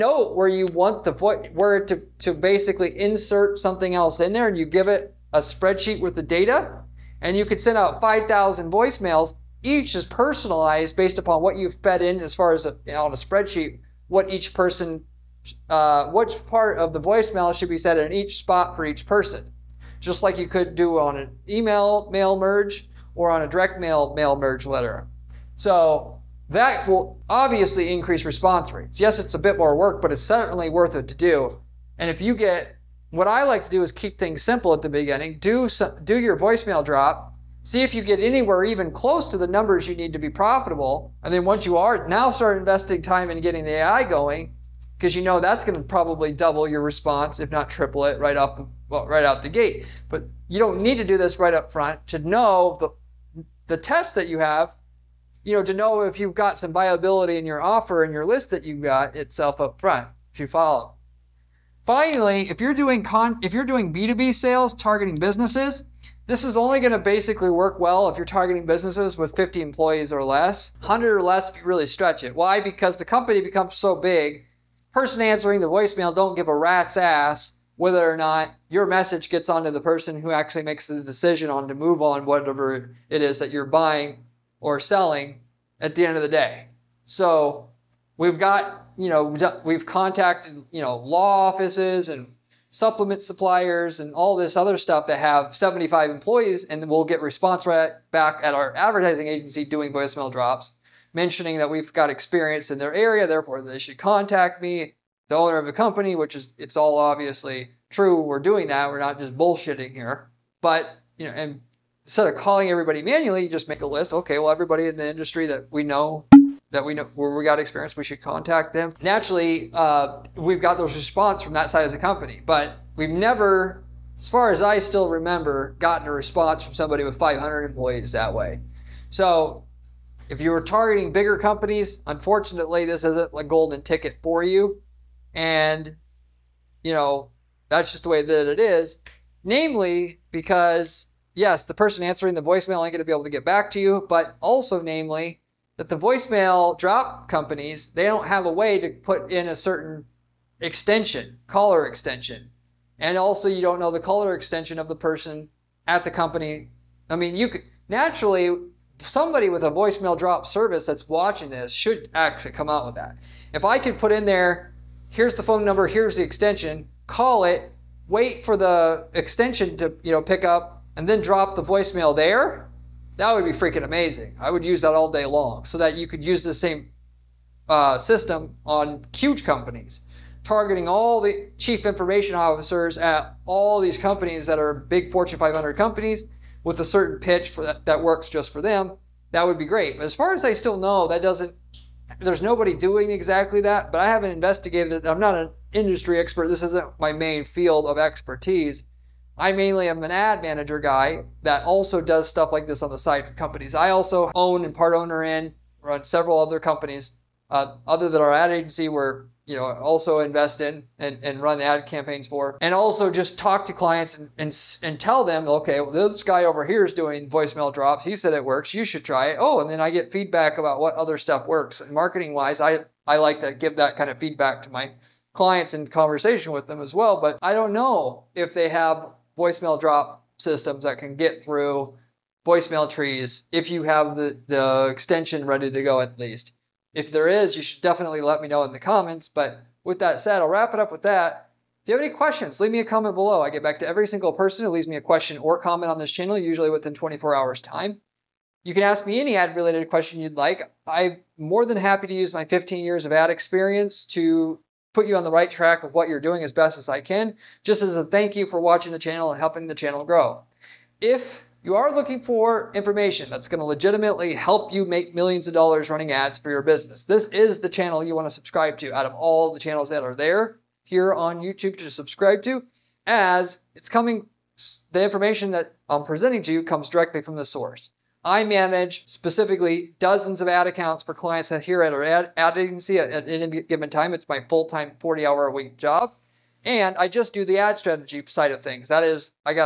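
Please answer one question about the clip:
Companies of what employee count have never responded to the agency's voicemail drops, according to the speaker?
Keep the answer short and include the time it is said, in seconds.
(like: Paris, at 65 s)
500, at 127 s.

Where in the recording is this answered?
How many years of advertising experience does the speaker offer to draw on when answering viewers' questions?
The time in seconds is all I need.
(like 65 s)
252 s.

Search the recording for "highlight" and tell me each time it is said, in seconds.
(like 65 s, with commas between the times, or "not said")
not said.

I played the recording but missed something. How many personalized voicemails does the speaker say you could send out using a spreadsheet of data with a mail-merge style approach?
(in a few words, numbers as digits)
5,000.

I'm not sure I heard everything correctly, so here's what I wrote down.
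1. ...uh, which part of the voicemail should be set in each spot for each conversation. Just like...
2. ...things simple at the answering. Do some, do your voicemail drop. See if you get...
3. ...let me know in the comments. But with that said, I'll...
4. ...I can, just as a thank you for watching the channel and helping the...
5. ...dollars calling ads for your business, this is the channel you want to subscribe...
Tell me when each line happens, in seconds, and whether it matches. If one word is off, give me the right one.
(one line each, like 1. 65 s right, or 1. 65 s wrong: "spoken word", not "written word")
1. 15 s wrong: "person", not "conversation"
2. 34 s wrong: "beginning", not "answering"
3. 238 s right
4. 256 s right
5. 265 s wrong: "running", not "calling".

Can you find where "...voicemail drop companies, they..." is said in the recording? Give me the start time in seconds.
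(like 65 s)
145 s.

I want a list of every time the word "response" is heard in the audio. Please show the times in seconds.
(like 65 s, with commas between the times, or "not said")
28 s, 46 s, 97 s, 120 s, 126 s.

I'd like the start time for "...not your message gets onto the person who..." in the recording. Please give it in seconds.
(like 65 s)
78 s.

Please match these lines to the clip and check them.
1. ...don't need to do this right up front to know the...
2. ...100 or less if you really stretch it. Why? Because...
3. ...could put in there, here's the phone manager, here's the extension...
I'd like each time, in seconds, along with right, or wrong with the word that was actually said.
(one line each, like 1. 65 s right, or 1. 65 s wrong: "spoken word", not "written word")
1. 50 s right
2. 70 s right
3. 163 s wrong: "number", not "manager".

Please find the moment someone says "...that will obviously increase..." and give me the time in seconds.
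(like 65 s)
26 s.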